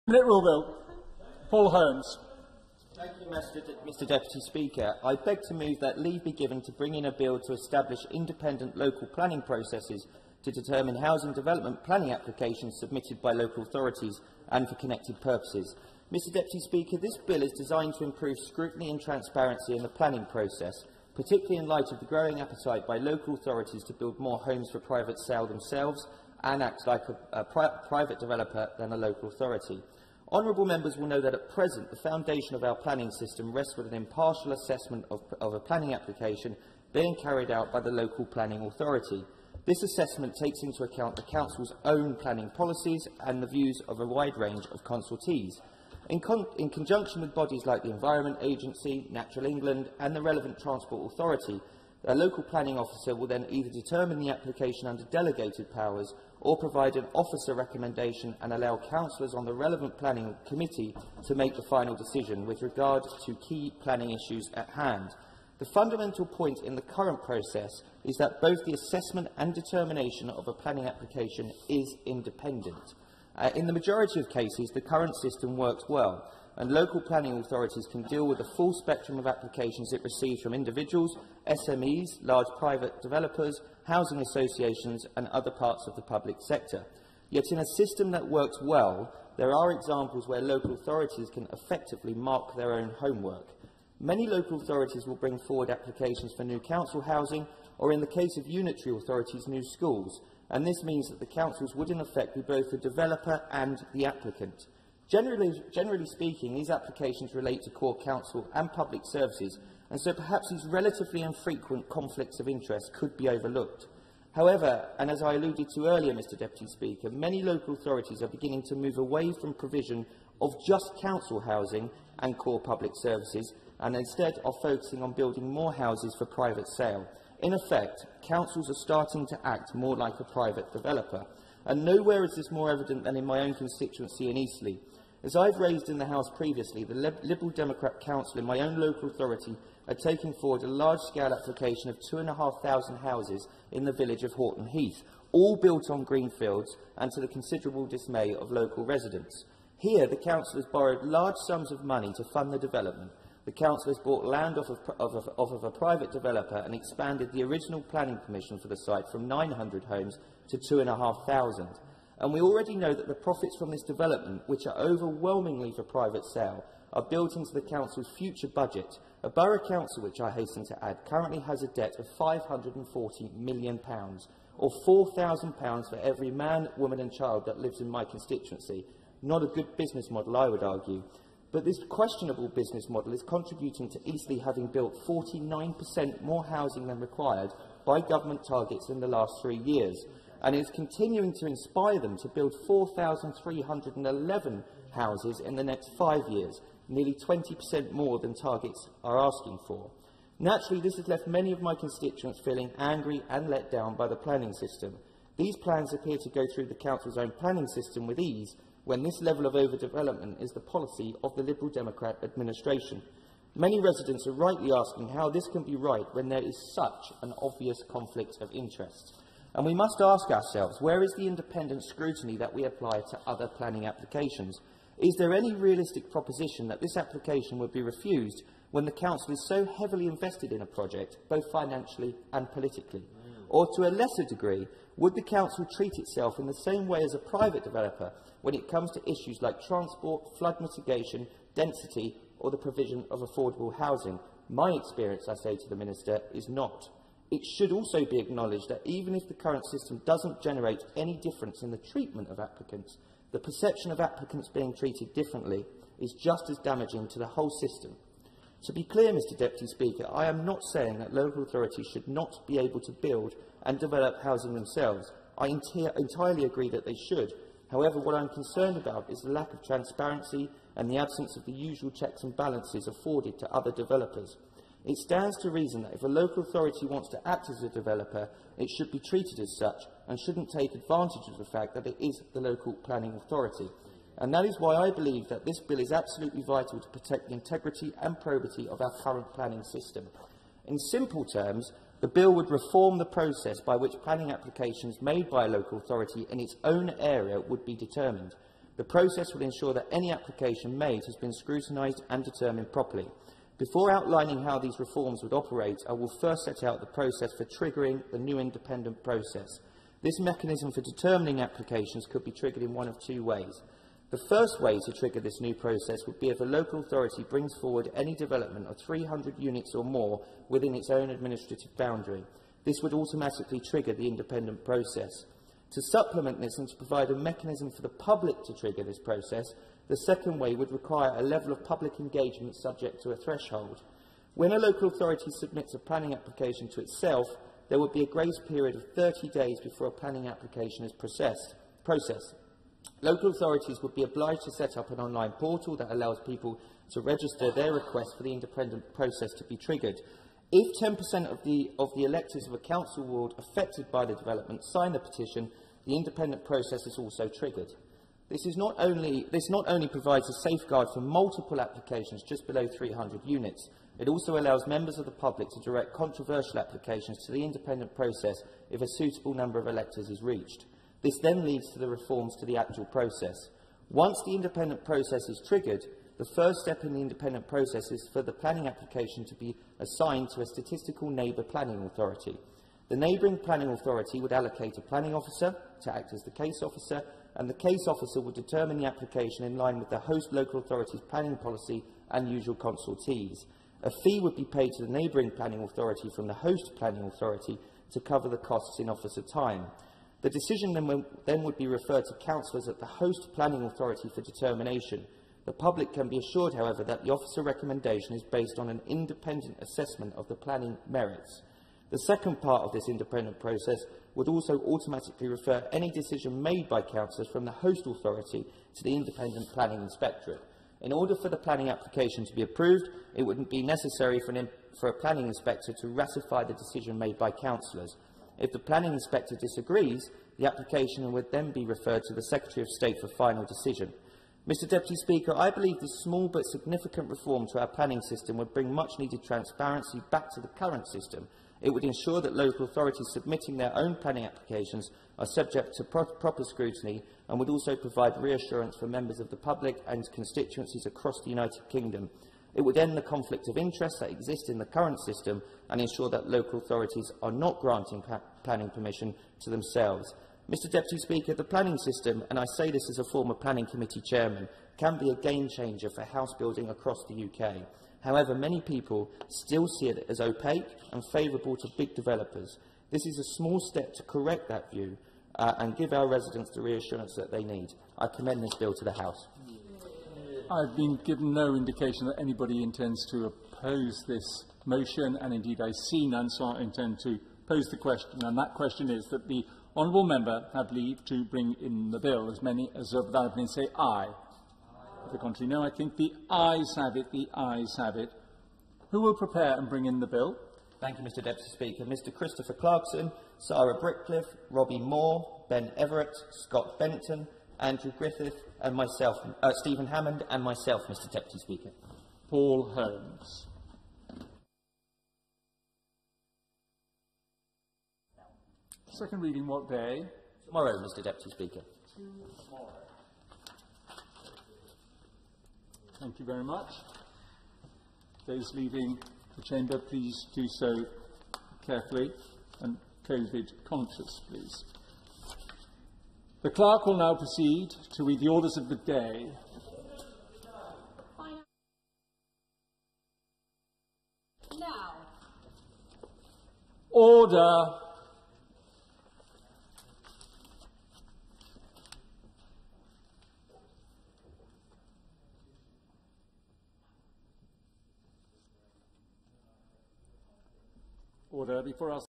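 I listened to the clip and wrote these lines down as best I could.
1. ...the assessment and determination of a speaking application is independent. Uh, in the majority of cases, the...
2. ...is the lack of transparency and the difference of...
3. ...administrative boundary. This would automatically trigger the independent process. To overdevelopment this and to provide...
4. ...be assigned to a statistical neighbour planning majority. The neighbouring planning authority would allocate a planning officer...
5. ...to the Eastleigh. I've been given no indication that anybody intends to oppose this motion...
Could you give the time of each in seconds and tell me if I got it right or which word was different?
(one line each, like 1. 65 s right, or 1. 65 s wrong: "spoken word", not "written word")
1. 68 s wrong: "planning", not "speaking"
2. 269 s wrong: "absence", not "difference"
3. 321 s wrong: "supplement", not "overdevelopment"
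4. 379 s wrong: "authority", not "majority"
5. 478 s wrong: "House", not "Eastleigh".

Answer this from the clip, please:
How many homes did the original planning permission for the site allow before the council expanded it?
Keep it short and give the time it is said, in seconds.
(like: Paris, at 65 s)
900, at 159 s.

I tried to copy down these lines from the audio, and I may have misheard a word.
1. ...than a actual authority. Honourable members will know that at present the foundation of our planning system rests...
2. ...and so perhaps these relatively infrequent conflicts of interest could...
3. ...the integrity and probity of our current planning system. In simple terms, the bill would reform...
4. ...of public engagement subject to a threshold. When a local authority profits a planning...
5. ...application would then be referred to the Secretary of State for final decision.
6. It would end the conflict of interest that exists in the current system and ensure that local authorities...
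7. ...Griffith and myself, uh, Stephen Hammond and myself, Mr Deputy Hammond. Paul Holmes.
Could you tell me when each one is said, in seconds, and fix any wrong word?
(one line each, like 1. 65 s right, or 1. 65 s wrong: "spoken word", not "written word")
1. 28 s wrong: "local", not "actual"
2. 109 s right
3. 287 s right
4. 331 s wrong: "submits", not "profits"
5. 430 s right
6. 452 s right
7. 507 s wrong: "Speaker", not "Hammond".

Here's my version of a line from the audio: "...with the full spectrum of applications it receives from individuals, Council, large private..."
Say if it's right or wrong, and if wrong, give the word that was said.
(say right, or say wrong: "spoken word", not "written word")
wrong: "SMEs", not "Council".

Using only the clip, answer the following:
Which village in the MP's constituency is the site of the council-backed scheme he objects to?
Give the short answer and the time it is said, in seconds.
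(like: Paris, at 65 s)
Horton Heath, at 144 s.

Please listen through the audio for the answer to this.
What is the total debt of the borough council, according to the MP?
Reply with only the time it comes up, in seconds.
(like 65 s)
172 s.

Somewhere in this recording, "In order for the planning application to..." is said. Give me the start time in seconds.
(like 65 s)
420 s.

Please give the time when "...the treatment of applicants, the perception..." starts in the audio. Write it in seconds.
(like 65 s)
251 s.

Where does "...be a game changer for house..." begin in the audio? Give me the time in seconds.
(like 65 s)
464 s.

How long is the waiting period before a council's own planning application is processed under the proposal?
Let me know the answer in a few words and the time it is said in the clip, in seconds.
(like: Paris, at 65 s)
30 days, at 338 s.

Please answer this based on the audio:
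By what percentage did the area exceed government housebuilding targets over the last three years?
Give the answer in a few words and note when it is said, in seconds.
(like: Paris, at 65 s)
49%, at 185 s.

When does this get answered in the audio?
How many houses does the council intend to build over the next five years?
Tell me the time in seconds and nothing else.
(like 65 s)
192 s.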